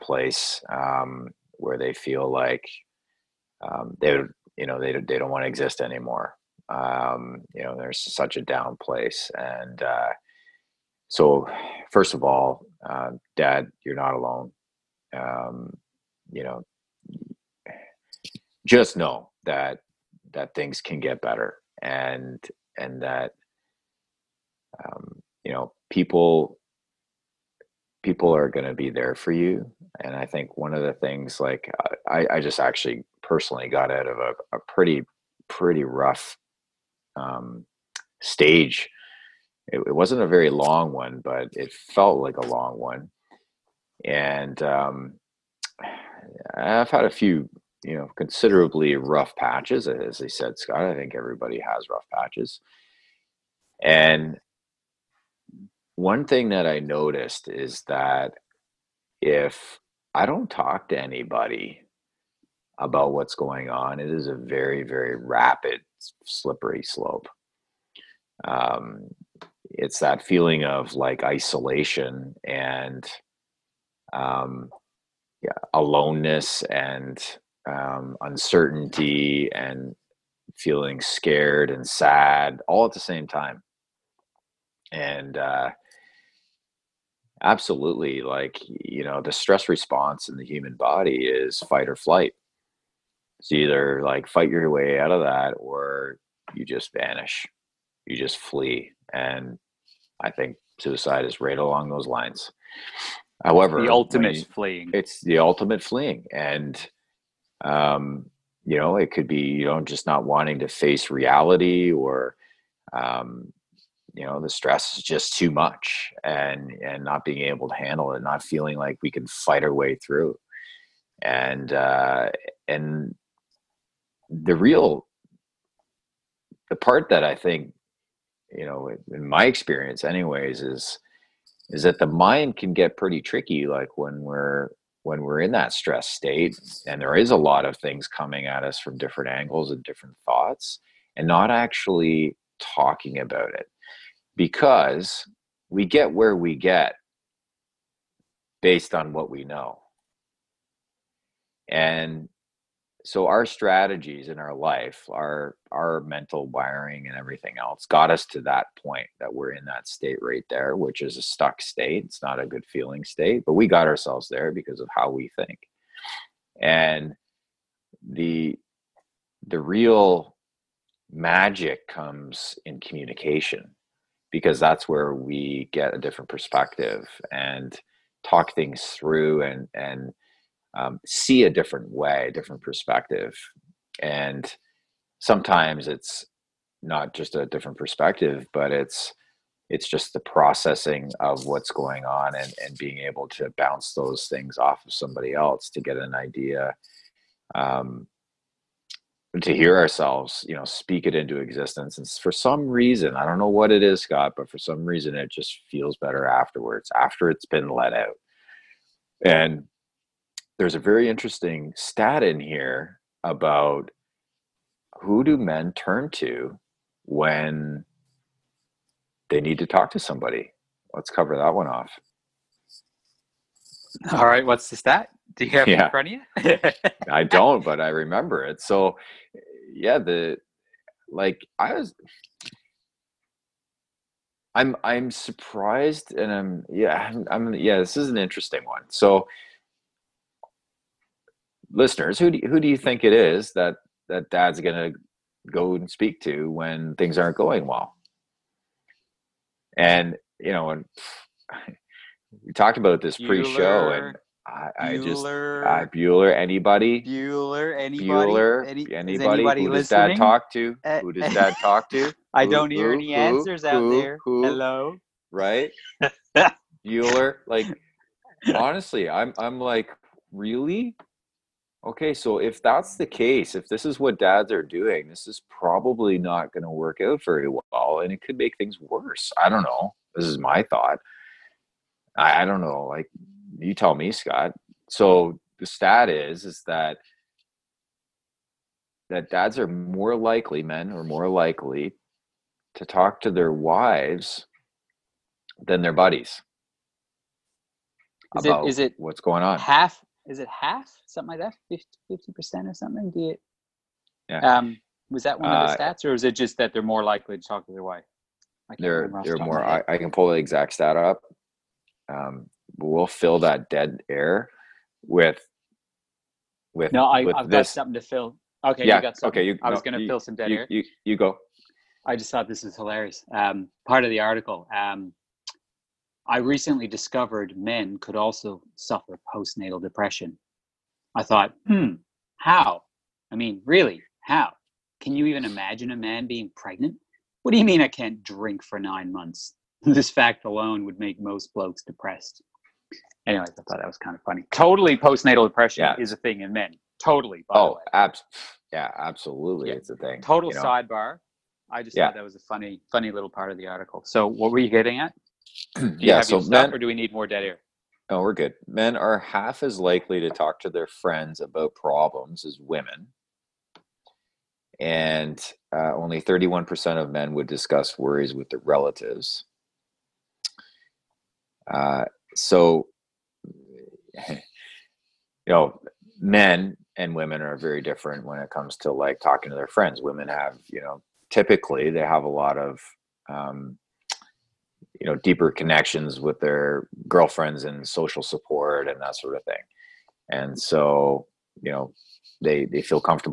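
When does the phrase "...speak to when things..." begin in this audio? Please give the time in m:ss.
4:05.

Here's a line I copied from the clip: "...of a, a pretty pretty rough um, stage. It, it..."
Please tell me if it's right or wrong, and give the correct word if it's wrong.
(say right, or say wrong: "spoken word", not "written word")
right.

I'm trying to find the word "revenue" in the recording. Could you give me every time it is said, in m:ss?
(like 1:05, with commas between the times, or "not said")
not said.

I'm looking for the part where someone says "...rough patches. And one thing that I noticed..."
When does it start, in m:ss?
0:51.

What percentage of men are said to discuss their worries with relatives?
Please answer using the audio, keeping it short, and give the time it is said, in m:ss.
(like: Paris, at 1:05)
31%, at 6:06.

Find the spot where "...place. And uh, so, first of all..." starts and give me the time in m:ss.
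0:08.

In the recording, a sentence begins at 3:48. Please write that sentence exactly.
So, yeah, the like I was I'm I'm surprised and I'm yeah, I'm, I'm yeah, this is an interesting one.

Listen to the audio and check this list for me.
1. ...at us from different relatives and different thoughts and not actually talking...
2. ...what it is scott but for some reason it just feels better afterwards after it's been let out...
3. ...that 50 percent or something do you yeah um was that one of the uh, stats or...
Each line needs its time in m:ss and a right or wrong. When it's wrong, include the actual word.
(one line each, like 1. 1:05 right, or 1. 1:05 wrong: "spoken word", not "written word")
1. 2:18 wrong: "angles", not "relatives"
2. 3:23 right
3. 5:01 right.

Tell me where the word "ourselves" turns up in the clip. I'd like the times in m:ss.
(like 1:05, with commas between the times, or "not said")
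2:43, 3:19.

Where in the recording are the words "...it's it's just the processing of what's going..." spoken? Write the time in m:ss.
3:08.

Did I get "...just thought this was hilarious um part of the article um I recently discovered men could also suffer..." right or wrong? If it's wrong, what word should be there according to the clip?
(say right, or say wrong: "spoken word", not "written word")
right.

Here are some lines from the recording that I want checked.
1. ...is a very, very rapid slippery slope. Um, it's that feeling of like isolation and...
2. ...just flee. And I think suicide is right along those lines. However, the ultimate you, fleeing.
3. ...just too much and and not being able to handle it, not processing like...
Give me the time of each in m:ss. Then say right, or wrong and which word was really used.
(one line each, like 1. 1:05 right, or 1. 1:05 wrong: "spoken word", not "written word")
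1. 1:04 right
2. 1:38 right
3. 1:55 wrong: "feeling", not "processing".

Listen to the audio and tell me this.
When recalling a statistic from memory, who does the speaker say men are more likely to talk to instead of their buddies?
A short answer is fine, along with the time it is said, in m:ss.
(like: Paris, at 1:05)
their wives, at 4:53.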